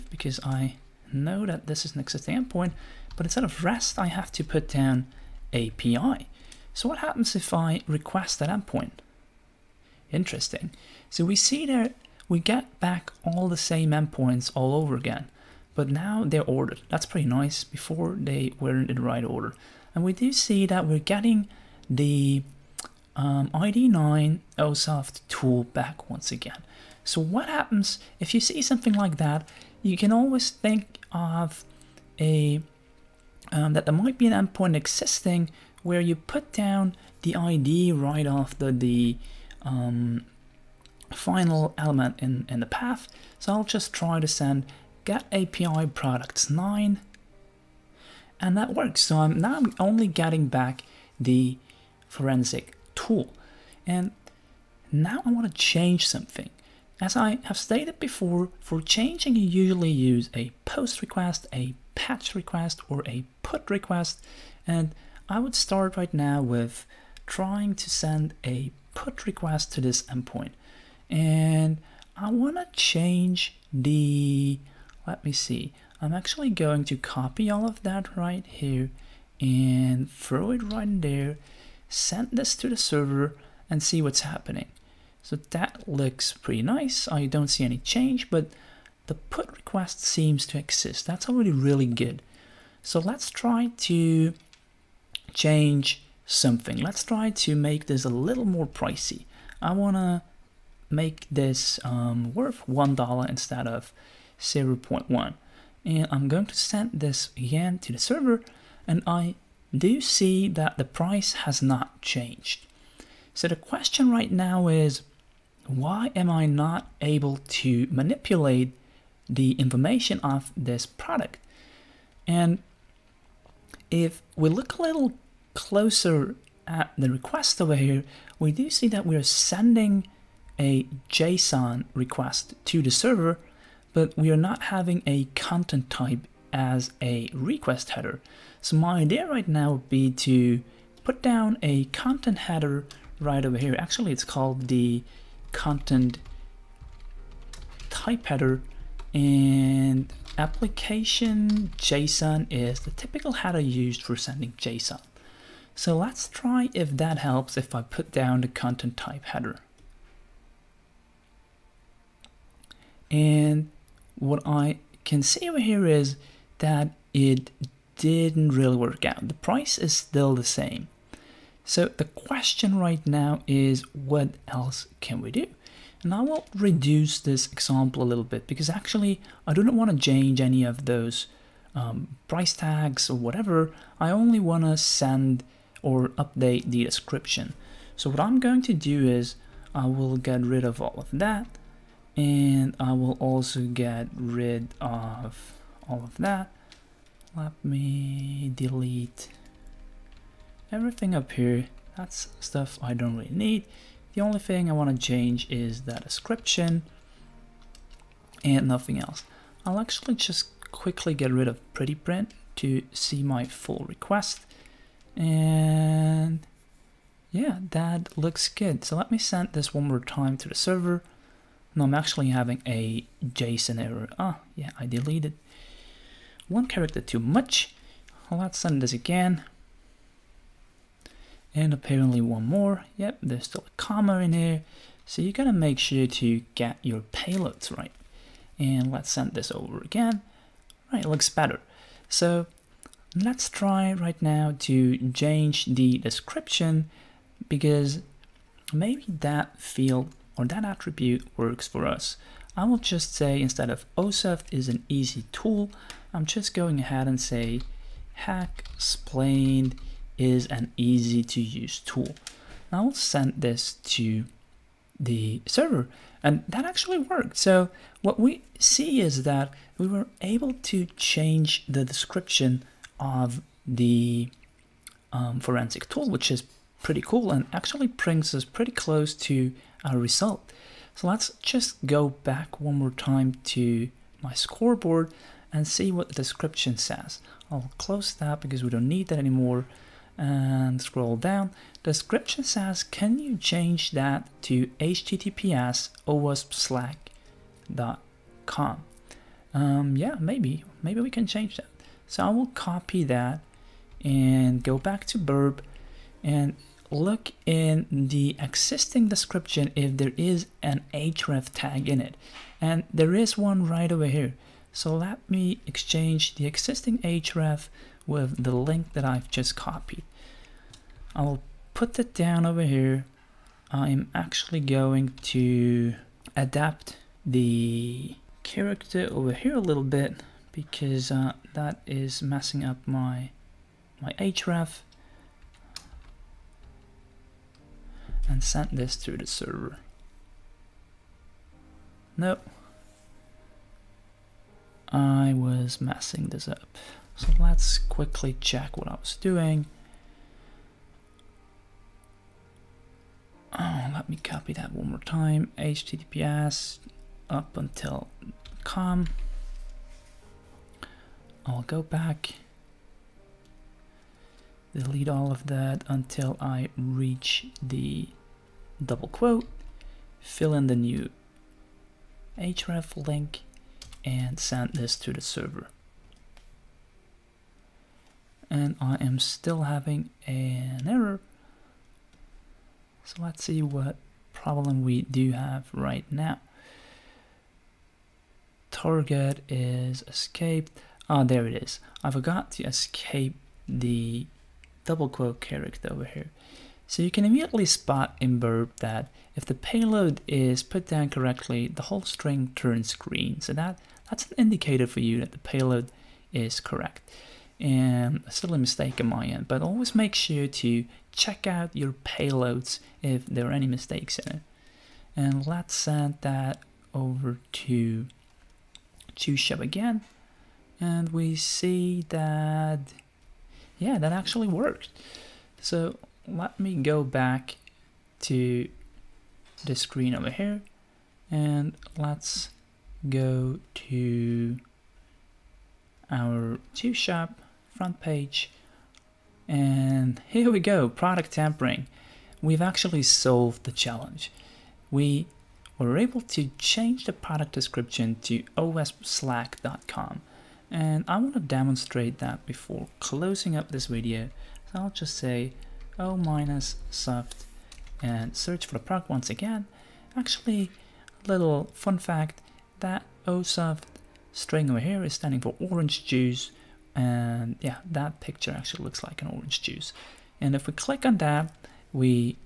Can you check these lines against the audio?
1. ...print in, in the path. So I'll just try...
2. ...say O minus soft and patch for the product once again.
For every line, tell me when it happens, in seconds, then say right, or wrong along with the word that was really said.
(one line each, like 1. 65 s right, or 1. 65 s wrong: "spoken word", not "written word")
1. 41 s wrong: "element", not "print"
2. 455 s wrong: "search", not "patch".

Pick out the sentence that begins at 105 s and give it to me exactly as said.
And I'm going to send this again to the server and I do see that the price has not changed.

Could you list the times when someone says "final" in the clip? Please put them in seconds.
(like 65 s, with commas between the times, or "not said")
41 s.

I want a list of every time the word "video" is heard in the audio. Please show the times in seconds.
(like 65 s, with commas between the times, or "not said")
453 s.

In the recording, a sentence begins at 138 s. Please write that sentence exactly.
So my idea right now would be to put down a content header right over here.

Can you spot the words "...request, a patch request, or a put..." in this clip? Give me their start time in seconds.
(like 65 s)
61 s.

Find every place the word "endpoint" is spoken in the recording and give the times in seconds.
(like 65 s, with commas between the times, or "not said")
2 s, 8 s, 13 s, 34 s, 70 s.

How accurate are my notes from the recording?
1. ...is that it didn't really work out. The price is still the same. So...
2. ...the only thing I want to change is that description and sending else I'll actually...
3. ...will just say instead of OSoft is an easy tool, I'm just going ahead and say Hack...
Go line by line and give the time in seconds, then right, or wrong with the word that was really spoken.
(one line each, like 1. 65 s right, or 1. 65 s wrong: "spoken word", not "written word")
1. 165 s right
2. 204 s wrong: "nothing", not "sending"
3. 252 s wrong: "OSEF", not "OSoft".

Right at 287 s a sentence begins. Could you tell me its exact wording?
I'll close that because we don't need that anymore and scroll down.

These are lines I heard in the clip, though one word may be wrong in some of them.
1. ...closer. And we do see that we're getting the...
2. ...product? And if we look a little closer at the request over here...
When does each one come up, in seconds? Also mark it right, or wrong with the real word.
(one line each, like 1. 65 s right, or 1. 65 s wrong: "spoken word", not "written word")
1. 19 s wrong: "order", not "closer"
2. 120 s right.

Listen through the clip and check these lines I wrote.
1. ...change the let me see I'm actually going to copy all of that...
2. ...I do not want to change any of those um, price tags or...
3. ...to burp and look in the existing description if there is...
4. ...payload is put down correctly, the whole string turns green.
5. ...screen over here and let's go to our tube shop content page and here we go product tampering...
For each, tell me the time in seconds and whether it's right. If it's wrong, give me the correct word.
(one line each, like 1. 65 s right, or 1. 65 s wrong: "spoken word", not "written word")
1. 72 s right
2. 179 s right
3. 305 s right
4. 399 s right
5. 429 s wrong: "front", not "content".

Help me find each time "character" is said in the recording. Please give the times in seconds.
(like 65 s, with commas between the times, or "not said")
226 s, 328 s, 395 s.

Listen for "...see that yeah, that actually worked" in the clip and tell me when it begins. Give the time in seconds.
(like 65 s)
421 s.